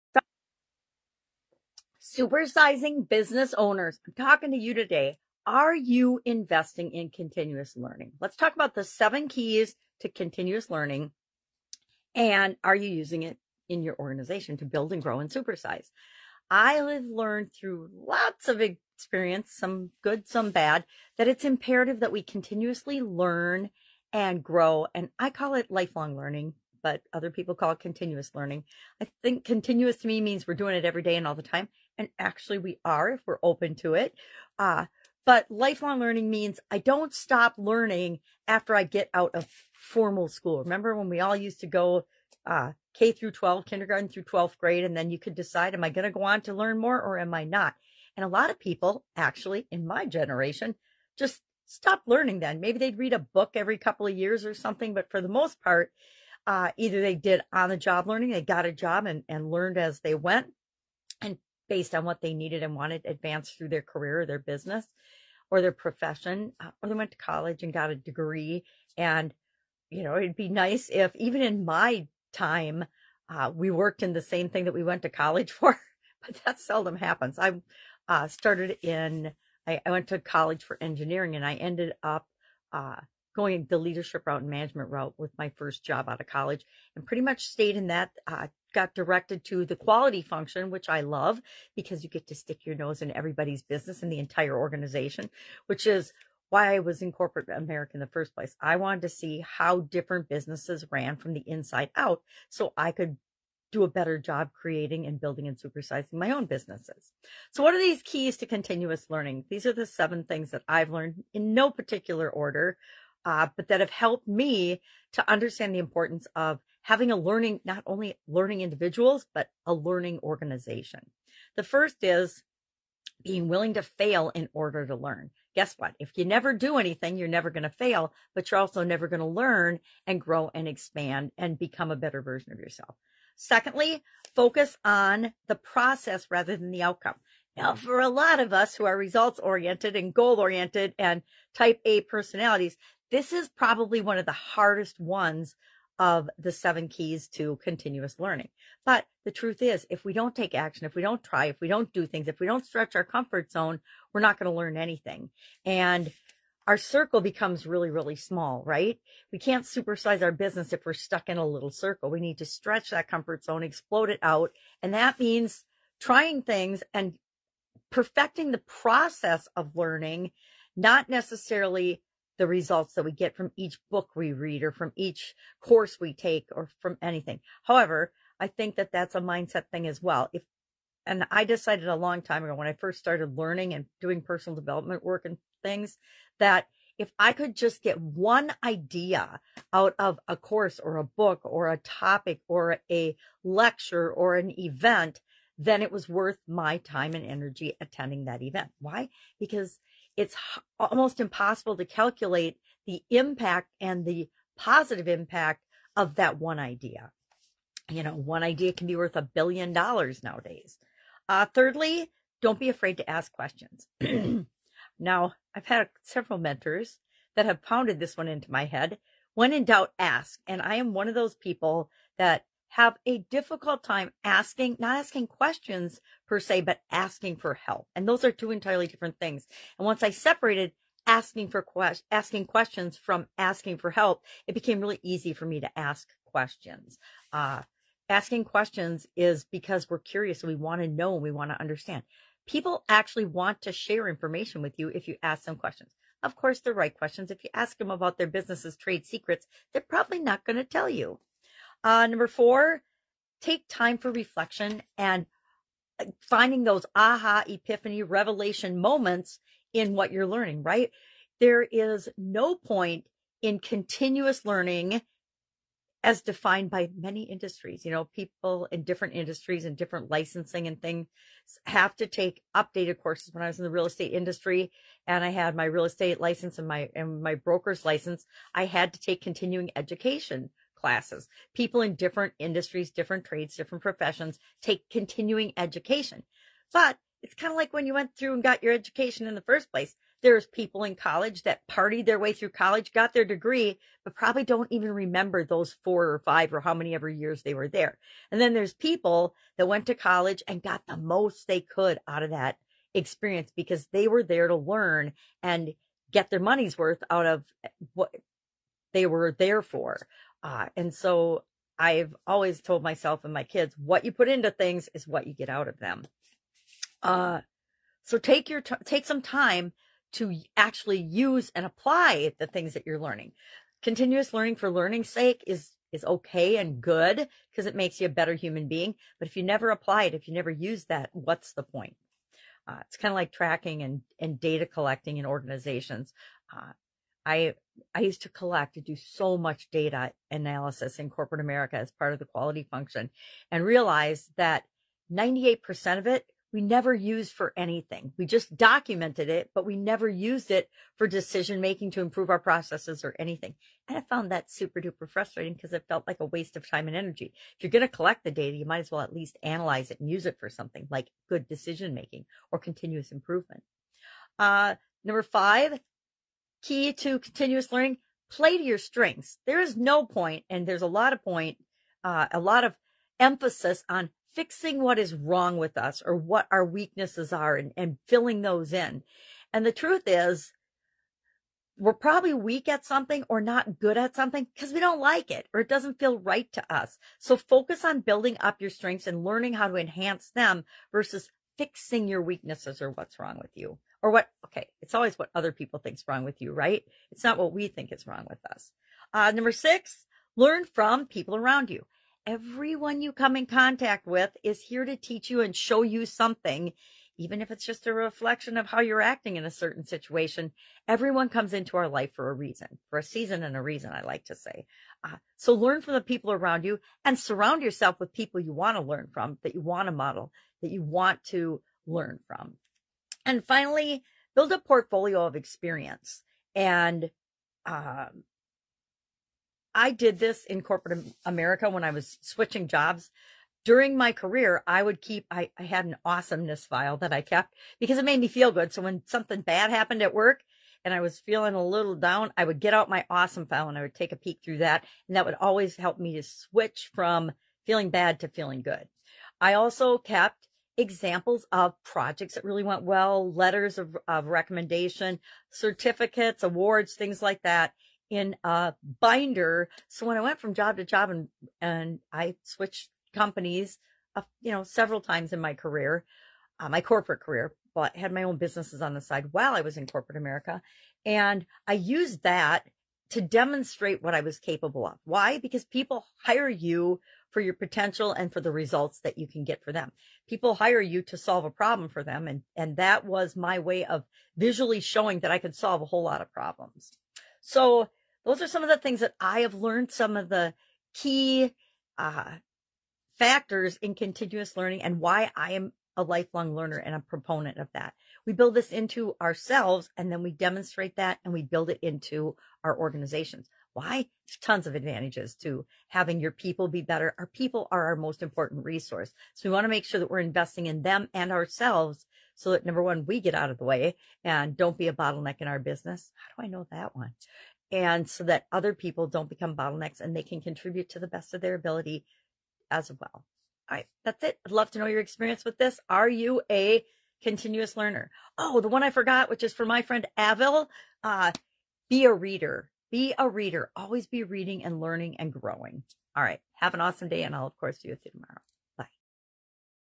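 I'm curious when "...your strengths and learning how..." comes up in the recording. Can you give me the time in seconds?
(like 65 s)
388 s.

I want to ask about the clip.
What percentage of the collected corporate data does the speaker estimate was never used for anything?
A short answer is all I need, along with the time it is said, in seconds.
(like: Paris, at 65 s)
98%, at 345 s.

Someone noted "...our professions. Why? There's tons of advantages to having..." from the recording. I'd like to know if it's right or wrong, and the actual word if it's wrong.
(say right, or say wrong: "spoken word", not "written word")
wrong: "organizations", not "professions".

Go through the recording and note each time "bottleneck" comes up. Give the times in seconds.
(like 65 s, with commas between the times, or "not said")
514 s, 519 s.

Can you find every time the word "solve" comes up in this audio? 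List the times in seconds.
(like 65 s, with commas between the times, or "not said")
481 s, 485 s.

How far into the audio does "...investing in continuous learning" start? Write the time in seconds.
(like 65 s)
6 s.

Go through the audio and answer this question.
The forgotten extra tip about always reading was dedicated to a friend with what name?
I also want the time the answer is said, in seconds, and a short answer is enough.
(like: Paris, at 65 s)
Avil, at 530 s.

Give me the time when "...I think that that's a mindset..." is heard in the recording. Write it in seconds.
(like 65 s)
178 s.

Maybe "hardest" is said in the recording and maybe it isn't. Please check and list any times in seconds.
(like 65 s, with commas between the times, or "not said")
144 s.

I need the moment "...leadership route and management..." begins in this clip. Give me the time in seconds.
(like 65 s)
83 s.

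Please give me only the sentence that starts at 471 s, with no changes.
And I used that to demonstrate what I was capable of.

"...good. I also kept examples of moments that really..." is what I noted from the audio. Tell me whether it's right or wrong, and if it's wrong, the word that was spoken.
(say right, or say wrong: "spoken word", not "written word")
wrong: "projects", not "moments".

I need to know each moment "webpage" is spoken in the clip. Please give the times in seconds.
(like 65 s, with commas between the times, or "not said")
not said.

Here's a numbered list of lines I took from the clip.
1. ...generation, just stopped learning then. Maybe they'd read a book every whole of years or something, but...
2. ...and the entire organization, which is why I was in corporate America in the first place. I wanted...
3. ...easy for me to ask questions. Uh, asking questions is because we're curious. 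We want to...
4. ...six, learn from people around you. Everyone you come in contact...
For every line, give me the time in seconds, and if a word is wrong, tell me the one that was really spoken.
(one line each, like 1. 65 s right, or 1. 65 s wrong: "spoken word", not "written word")
1. 50 s wrong: "couple", not "whole"
2. 94 s right
3. 235 s right
4. 399 s right.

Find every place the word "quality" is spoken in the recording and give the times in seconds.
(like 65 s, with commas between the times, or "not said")
89 s, 342 s.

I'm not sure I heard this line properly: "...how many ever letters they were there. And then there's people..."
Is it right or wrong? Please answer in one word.
wrong.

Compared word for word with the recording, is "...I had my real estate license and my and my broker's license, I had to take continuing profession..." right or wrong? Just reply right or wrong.
wrong.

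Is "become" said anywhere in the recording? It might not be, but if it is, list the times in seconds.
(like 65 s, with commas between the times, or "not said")
131 s, 157 s, 519 s.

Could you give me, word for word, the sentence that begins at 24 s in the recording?
And I call it lifelong learning, but other people call it continuous learning.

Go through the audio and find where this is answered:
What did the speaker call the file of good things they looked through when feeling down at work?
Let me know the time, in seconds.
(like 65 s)
436 s.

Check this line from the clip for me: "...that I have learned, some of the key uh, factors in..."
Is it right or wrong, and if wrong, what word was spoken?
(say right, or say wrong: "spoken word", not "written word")
right.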